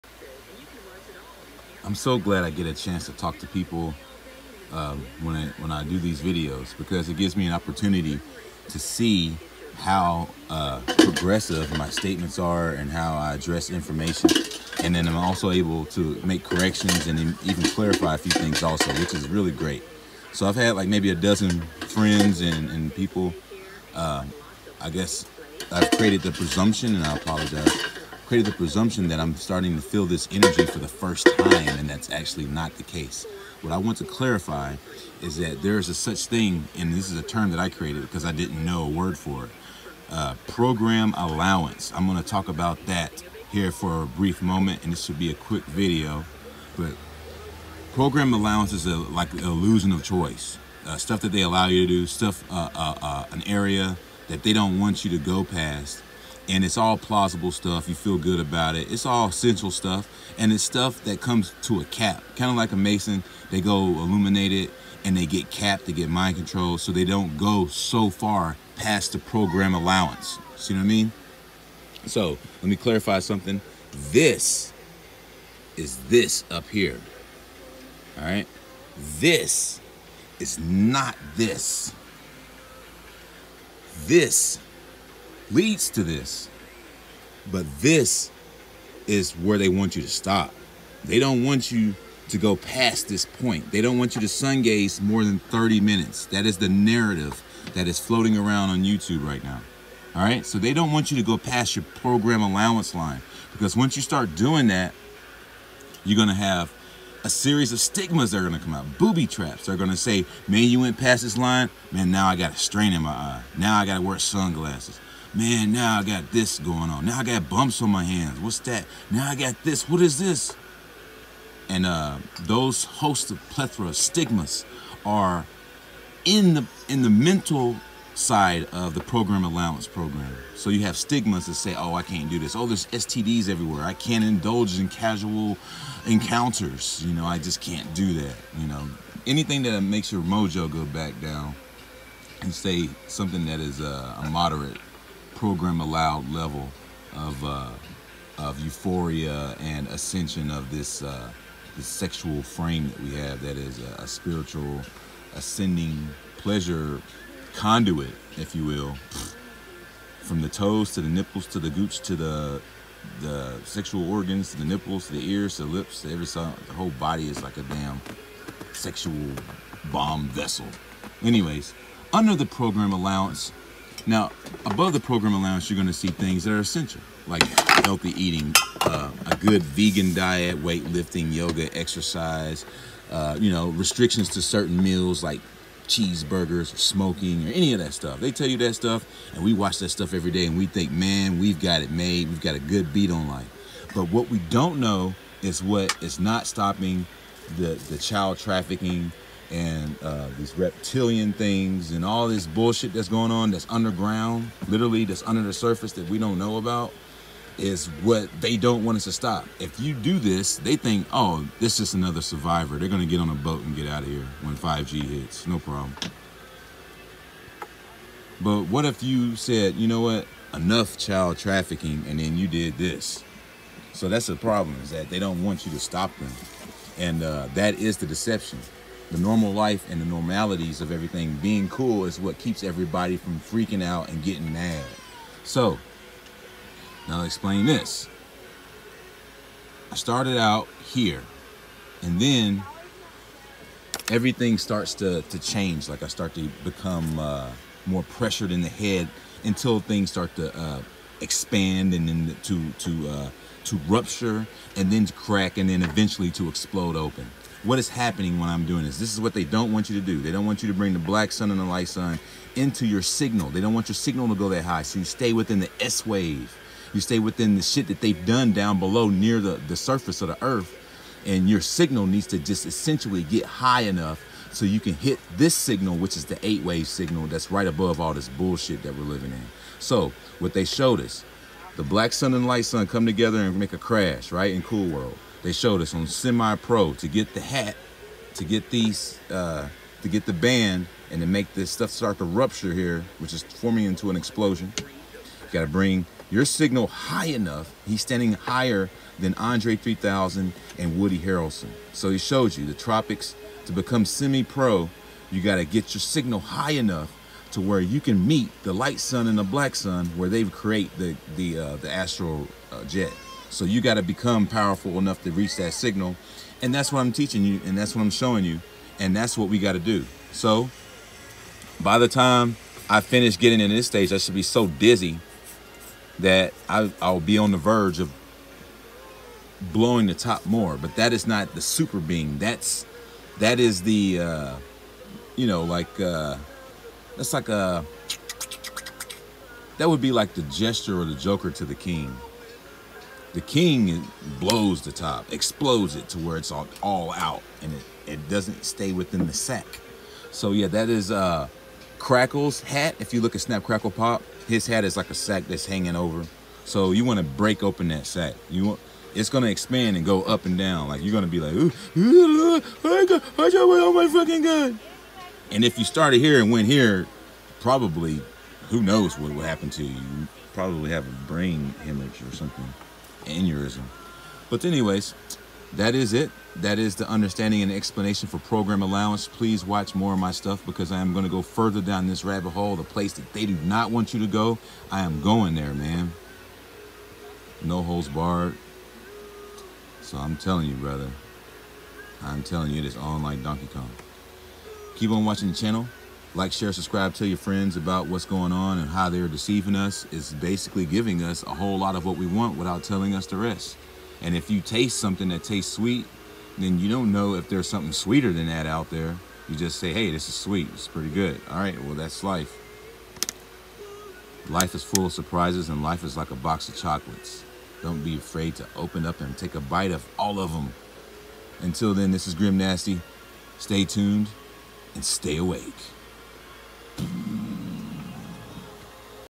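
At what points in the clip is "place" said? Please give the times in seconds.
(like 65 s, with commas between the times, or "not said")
382 s.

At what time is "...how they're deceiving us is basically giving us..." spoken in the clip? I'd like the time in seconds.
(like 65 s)
398 s.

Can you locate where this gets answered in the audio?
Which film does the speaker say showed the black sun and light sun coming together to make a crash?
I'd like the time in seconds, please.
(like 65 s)
284 s.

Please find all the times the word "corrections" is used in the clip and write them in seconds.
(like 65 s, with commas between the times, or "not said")
16 s.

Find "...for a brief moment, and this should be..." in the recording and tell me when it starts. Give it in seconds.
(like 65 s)
43 s.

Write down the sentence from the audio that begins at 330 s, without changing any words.
But that is not the super being.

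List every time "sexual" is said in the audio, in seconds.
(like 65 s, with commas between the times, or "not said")
151 s, 163 s, 168 s.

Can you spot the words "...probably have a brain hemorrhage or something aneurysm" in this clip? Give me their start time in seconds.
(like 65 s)
370 s.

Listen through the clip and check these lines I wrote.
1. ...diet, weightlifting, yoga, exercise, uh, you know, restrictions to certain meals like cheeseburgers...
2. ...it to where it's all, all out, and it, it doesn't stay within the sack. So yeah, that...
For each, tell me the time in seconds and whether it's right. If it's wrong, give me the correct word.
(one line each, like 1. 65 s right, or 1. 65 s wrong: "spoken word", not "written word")
1. 180 s right
2. 345 s right.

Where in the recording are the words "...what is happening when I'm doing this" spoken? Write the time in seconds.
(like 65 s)
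257 s.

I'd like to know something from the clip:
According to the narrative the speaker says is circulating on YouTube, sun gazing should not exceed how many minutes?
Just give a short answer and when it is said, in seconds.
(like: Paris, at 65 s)
30, at 95 s.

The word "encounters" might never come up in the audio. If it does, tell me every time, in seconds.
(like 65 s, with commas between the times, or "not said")
136 s.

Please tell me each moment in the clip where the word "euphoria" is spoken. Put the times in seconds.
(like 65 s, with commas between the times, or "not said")
148 s.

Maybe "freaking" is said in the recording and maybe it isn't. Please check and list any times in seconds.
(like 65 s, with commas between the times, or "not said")
233 s.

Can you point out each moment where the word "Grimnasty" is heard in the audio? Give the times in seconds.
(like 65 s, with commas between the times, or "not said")
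422 s.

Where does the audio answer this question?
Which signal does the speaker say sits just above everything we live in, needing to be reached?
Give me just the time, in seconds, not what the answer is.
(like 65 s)
276 s.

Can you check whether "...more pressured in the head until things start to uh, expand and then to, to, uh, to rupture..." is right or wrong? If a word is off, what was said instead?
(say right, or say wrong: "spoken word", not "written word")
right.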